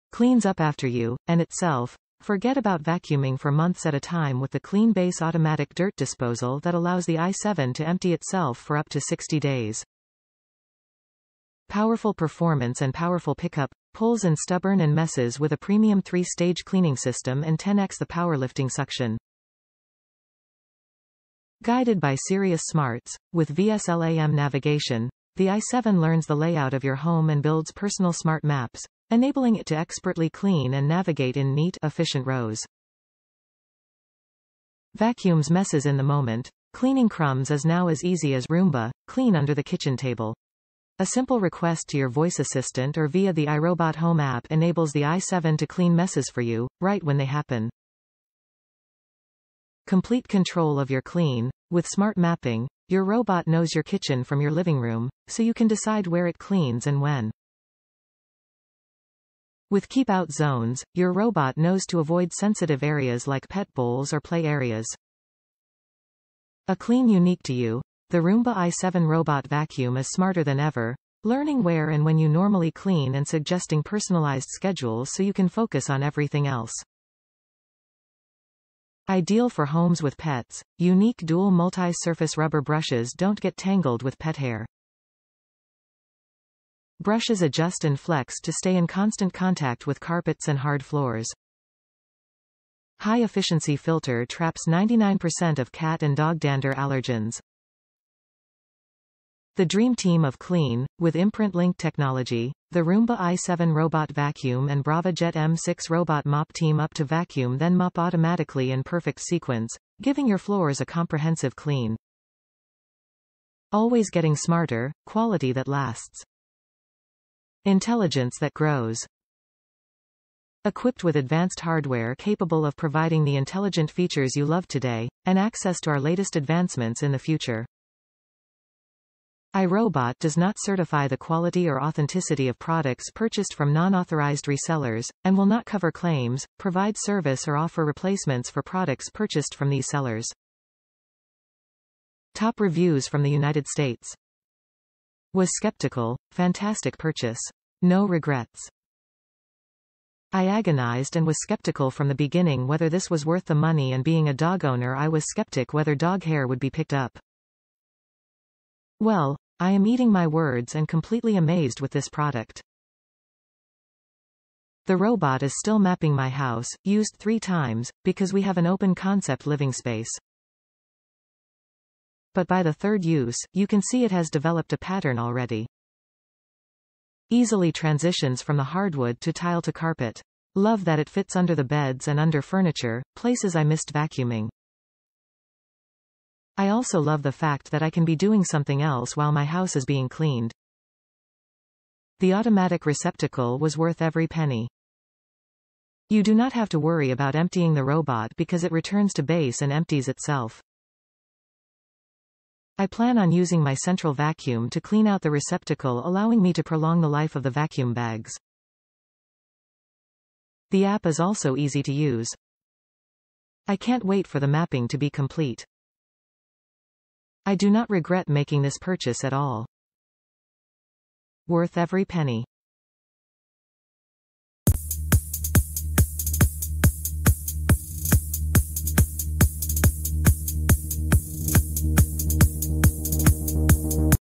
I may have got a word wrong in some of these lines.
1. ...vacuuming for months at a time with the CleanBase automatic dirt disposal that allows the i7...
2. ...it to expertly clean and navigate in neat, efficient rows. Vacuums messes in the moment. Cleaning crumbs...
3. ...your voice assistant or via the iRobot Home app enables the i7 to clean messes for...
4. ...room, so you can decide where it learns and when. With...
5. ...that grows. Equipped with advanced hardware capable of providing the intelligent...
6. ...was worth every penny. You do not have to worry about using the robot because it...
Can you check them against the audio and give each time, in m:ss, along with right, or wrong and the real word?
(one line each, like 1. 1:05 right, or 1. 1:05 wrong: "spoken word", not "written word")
1. 0:02 right
2. 0:29 right
3. 0:41 right
4. 0:54 wrong: "cleans", not "learns"
5. 1:58 right
6. 3:13 wrong: "emptying", not "using".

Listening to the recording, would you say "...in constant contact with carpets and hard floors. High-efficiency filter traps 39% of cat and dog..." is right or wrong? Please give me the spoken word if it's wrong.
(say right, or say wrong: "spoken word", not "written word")
wrong: "99", not "39".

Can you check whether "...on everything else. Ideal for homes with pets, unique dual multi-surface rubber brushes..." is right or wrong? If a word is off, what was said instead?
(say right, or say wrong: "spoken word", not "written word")
right.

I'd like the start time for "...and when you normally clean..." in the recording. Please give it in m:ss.
1:11.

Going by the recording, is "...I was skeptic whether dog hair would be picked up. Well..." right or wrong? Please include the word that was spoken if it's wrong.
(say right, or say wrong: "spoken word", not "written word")
right.